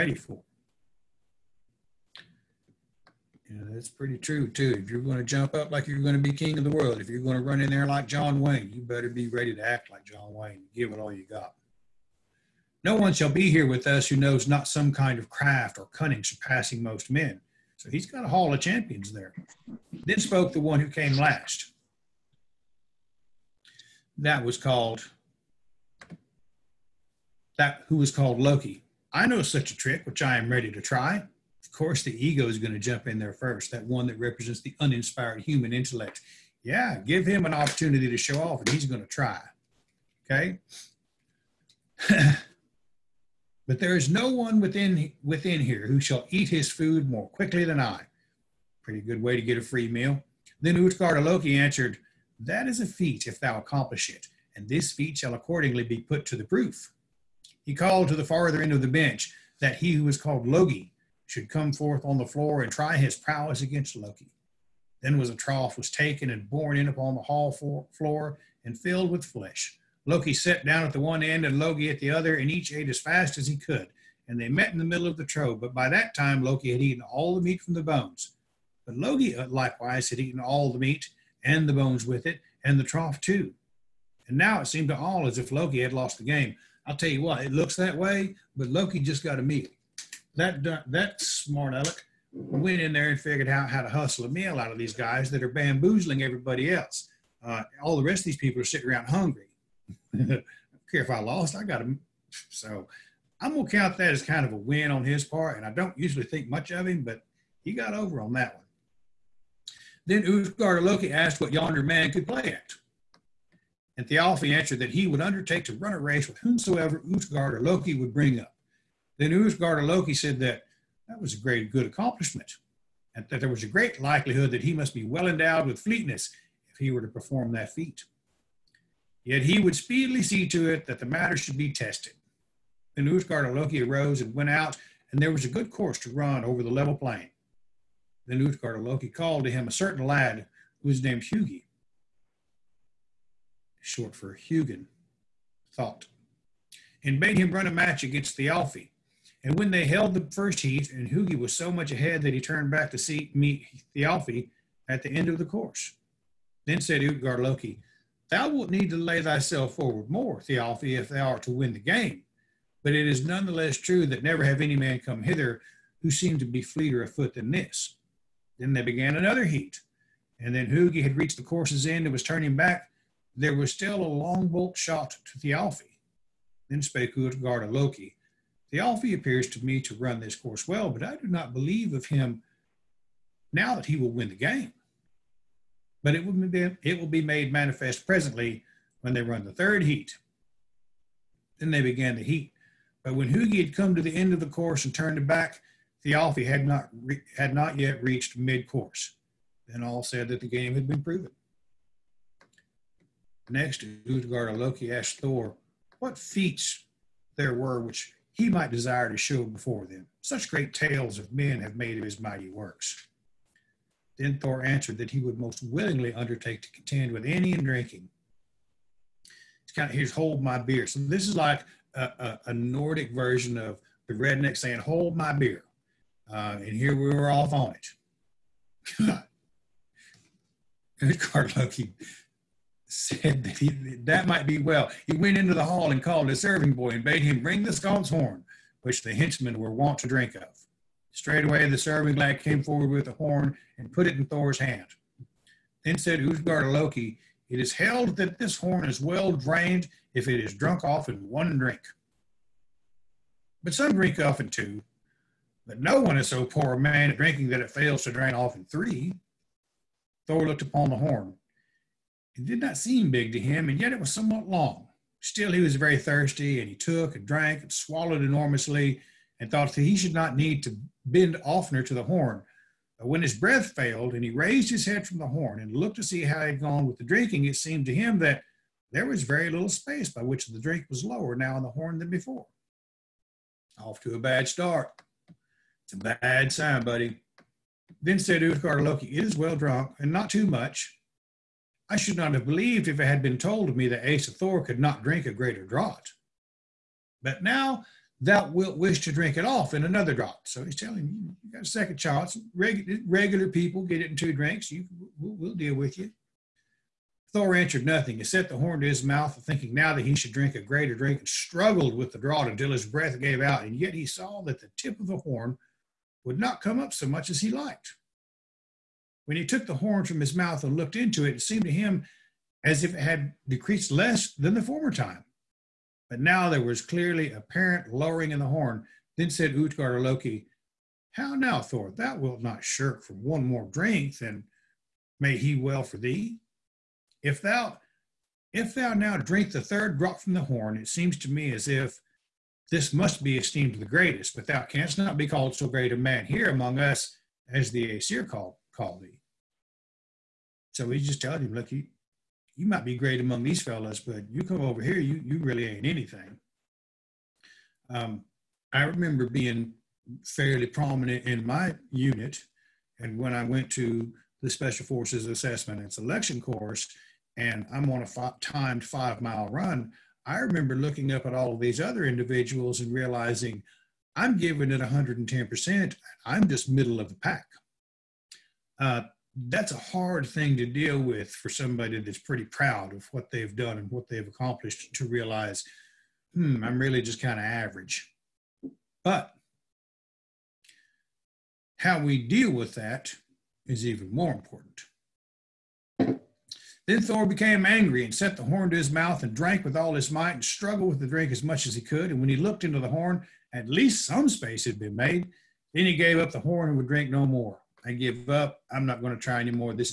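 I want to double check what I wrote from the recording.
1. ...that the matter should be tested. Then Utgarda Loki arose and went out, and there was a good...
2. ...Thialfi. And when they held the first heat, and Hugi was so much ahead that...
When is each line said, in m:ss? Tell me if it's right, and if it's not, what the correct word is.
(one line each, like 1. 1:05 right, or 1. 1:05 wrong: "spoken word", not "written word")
1. 2:10 right
2. 2:28 right.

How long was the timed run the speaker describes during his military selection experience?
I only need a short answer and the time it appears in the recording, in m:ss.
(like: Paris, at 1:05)
5 miles, at 6:08.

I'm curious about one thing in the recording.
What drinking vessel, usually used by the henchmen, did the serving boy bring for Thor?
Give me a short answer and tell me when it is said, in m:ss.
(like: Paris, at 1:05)
The skald's horn, at 3:57.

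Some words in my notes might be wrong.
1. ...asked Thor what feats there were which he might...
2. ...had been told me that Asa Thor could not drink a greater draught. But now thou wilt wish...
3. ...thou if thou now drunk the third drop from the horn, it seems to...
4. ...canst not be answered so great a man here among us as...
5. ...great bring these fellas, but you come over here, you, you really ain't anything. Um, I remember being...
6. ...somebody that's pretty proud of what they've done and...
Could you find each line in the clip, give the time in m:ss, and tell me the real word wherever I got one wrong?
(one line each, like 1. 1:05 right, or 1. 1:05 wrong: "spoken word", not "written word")
1. 3:24 right
2. 4:53 right
3. 5:37 wrong: "drink", not "drunk"
4. 5:44 wrong: "called", not "answered"
5. 5:52 wrong: "among", not "bring"
6. 6:21 right.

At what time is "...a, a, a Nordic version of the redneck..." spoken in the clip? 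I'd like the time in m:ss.
3:41.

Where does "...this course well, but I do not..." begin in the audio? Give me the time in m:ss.
3:00.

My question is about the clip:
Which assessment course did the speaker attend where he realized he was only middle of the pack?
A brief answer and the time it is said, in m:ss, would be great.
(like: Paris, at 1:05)
Special Forces Assessment and Selection, at 6:04.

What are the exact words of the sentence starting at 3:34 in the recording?
Then Thor answered that he would most willingly undertake to contend with any in drinking.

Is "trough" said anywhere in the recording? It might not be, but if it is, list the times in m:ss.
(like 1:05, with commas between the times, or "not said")
1:05, 1:15, 1:22.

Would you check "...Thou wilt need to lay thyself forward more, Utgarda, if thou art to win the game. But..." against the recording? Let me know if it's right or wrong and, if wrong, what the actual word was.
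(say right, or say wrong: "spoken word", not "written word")
wrong: "Thialfi", not "Utgarda".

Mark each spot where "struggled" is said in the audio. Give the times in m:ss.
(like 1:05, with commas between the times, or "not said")
5:11, 6:40.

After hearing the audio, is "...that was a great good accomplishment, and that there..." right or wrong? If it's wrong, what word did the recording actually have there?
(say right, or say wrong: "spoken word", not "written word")
right.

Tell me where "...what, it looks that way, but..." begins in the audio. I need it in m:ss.
1:27.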